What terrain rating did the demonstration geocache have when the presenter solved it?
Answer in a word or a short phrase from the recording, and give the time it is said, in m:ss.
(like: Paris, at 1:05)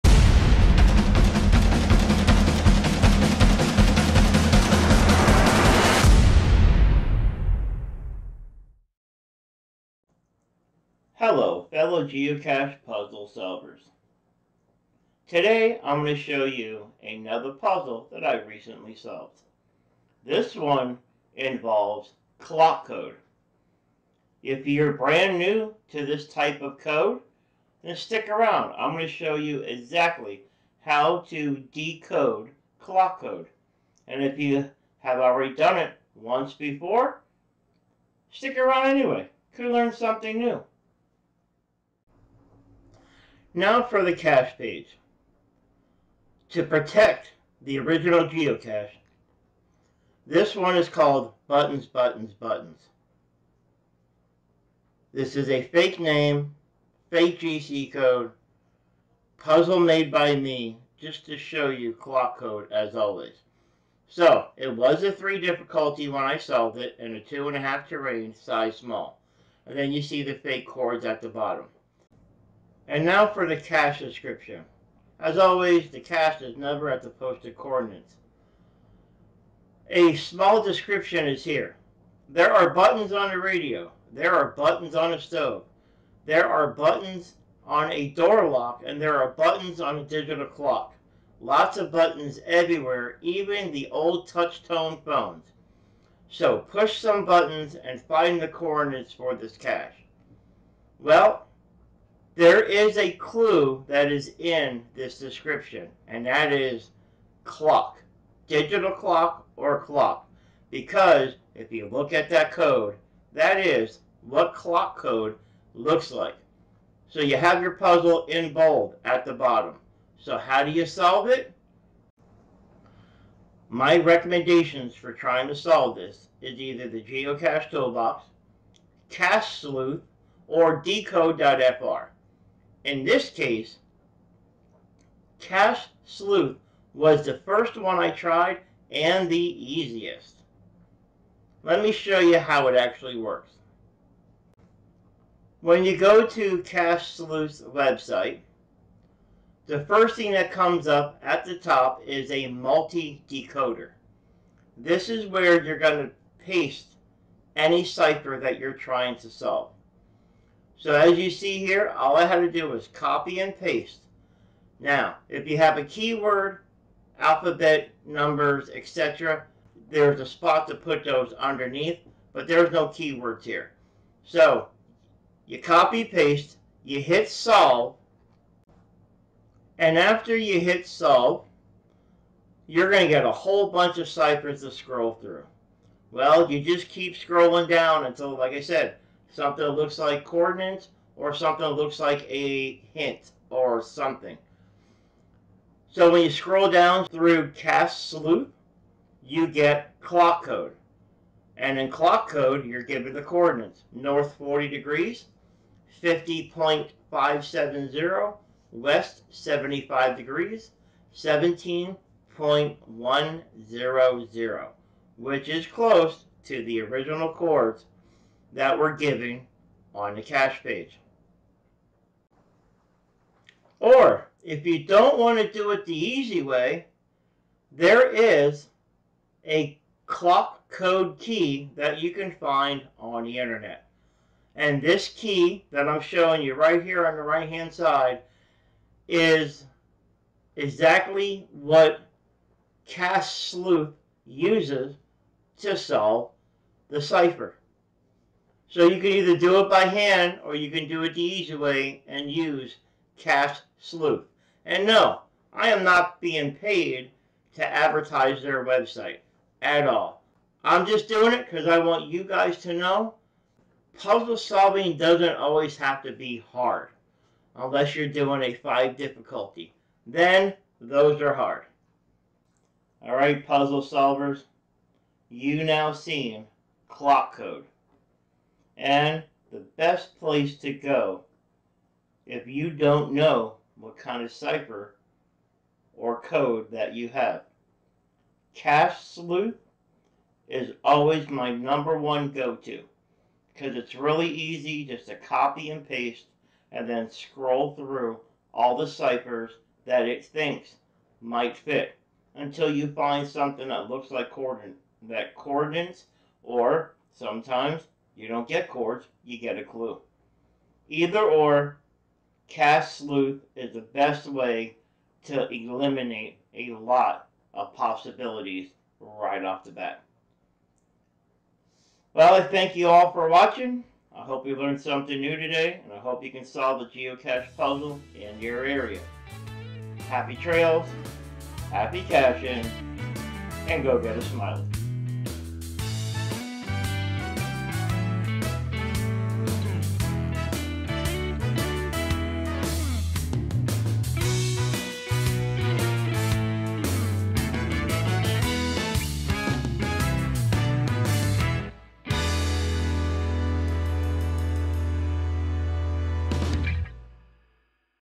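2.5, at 1:07.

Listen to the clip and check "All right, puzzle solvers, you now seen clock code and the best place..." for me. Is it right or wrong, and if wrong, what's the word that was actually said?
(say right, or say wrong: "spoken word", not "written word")
right.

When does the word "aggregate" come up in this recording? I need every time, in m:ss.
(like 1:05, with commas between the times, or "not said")
not said.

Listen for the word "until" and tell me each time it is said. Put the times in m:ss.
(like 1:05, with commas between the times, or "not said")
3:08, 5:02.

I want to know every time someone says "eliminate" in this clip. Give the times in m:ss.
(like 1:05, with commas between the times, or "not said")
5:15.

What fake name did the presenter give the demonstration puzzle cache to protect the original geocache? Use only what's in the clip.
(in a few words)
Buttons, Buttons, Buttons.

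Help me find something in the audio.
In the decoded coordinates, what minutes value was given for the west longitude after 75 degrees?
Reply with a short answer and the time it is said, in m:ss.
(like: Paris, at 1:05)
17.100, at 3:31.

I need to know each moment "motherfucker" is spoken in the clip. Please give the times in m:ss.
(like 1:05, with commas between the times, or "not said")
not said.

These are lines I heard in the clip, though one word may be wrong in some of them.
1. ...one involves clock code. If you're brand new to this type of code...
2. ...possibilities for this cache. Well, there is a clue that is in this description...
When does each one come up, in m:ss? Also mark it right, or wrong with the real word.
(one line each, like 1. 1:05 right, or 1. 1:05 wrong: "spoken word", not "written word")
1. 0:20 right
2. 1:38 wrong: "coordinates", not "possibilities".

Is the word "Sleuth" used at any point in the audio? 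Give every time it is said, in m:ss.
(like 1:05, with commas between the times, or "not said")
2:09, 2:16, 2:27, 3:17, 4:03, 4:13, 4:49, 5:12.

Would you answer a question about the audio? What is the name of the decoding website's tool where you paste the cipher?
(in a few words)
multi-decoder.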